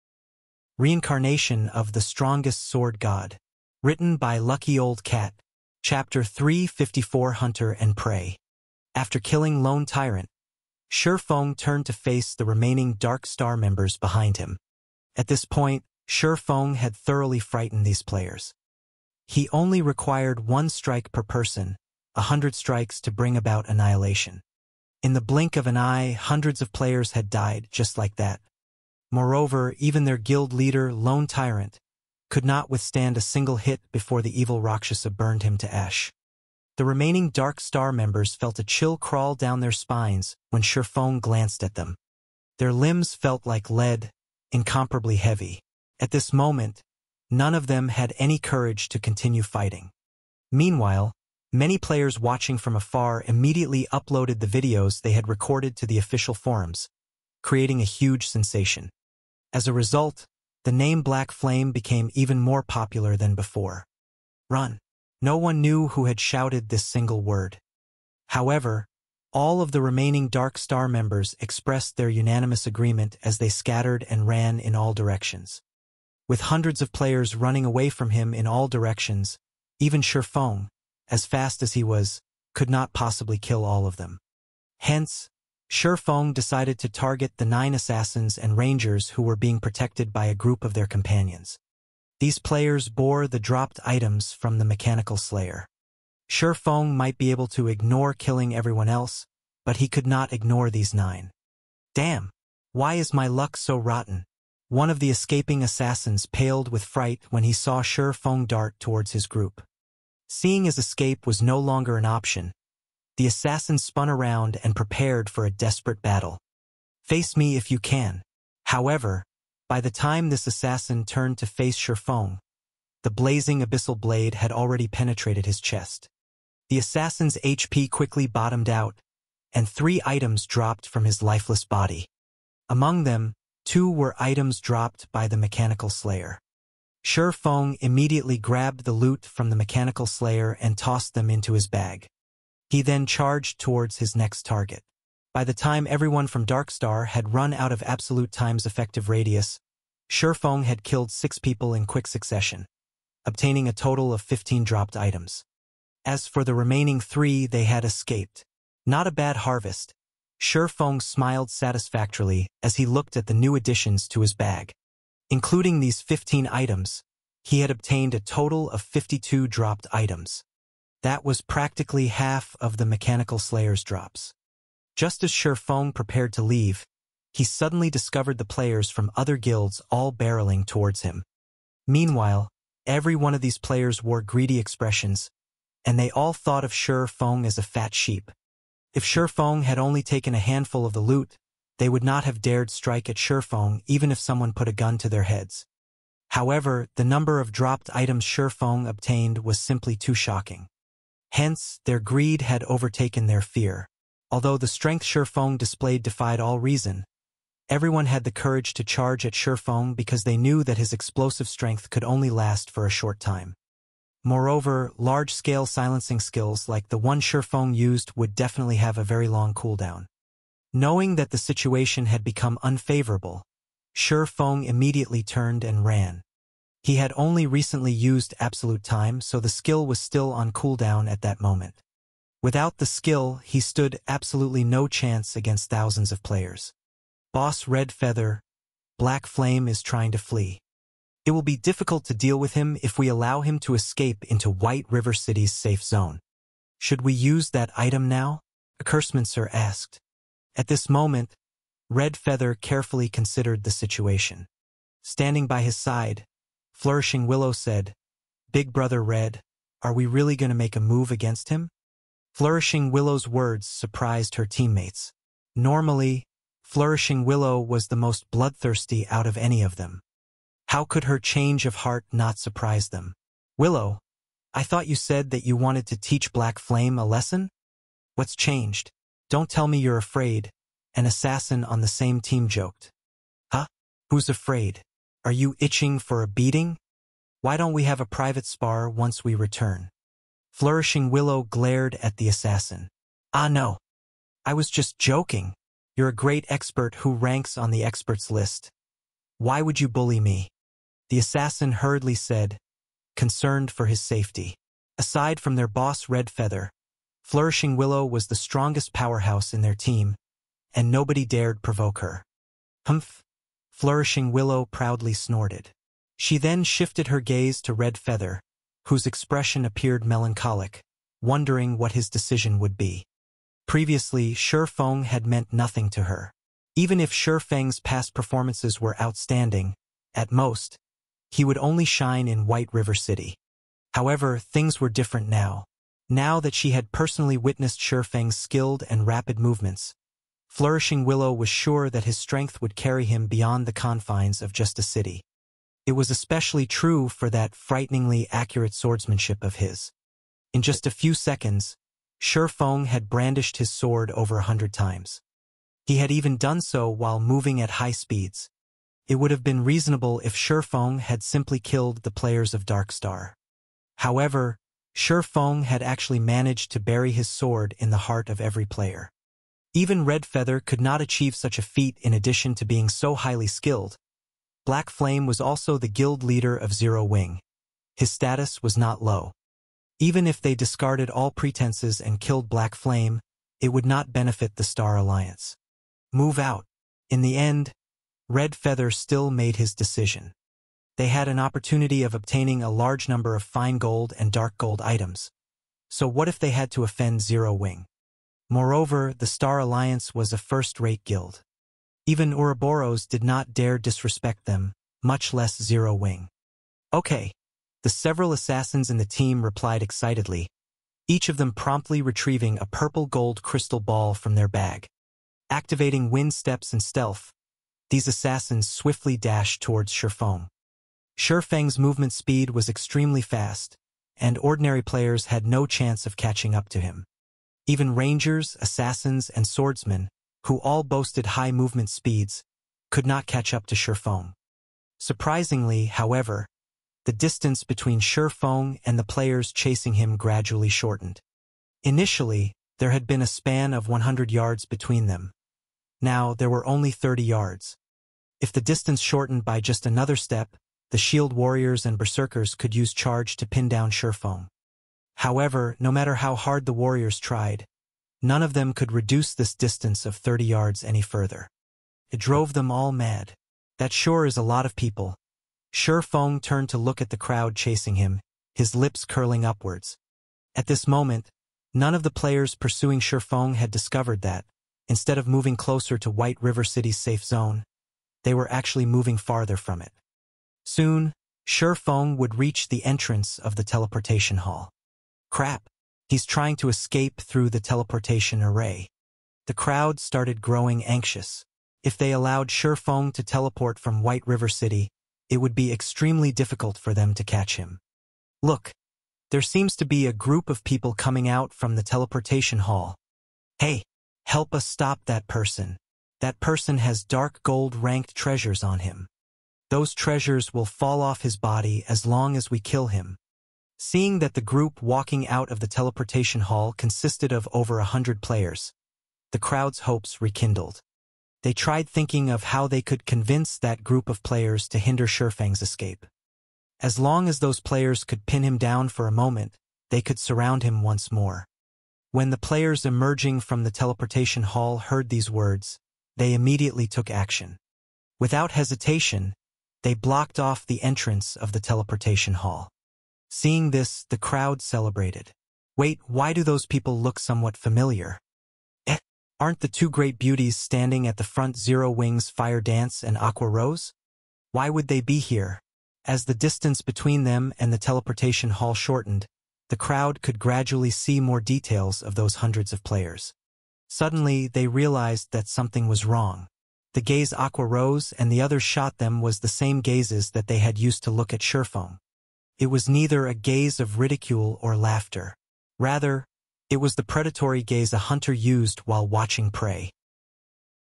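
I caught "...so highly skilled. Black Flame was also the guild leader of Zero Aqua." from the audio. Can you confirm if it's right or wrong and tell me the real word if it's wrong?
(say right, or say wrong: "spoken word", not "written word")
wrong: "Wing", not "Aqua".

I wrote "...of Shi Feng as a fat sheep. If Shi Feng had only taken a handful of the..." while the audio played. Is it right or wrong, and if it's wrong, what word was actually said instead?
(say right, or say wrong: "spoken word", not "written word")
right.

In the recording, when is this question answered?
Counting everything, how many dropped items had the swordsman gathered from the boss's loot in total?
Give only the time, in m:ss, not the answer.
2:48.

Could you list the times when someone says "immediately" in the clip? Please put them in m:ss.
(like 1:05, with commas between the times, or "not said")
0:53, 2:17, 3:44, 8:56.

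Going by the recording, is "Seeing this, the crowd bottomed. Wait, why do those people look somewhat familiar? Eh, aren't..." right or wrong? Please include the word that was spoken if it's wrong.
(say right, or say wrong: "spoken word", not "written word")
wrong: "celebrated", not "bottomed".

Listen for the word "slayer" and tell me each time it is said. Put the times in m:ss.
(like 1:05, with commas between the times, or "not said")
1:35, 2:15, 2:20, 2:53.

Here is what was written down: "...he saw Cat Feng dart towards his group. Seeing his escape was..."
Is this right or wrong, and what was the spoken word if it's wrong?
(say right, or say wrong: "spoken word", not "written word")
wrong: "Shi", not "Cat".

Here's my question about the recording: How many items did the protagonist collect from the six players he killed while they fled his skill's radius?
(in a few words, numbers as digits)
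15.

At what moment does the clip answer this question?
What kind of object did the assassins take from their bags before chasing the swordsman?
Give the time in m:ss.
6:52.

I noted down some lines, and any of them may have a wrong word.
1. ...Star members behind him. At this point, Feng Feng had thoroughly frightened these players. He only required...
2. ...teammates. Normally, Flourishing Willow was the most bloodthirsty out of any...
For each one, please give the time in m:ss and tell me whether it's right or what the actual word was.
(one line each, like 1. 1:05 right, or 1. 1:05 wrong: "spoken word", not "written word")
1. 0:13 wrong: "Shi", not "Feng"
2. 4:24 right.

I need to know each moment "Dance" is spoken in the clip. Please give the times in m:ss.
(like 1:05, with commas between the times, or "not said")
9:12.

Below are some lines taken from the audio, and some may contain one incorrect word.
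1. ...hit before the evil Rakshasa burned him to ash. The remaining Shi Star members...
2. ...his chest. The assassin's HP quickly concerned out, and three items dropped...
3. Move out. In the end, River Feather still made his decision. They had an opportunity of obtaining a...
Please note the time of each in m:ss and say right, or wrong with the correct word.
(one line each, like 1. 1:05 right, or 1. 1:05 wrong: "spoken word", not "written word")
1. 0:33 wrong: "Dark", not "Shi"
2. 2:05 wrong: "bottomed", not "concerned"
3. 6:26 wrong: "Red", not "River".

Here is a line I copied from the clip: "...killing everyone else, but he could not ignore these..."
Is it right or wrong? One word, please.
right.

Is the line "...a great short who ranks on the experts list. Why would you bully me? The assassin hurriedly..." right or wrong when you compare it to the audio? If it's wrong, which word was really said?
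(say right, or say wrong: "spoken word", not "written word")
wrong: "expert", not "short".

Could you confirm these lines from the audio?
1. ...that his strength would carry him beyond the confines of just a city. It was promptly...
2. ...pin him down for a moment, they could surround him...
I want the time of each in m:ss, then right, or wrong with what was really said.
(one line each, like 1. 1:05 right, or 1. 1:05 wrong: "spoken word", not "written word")
1. 5:41 wrong: "especially", not "promptly"
2. 8:48 right.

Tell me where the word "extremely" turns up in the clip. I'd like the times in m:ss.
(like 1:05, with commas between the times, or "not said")
7:02, 8:15.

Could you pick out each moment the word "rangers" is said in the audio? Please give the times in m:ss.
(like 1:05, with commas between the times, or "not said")
1:28, 7:07.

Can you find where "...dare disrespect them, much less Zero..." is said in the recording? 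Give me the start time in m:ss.
6:43.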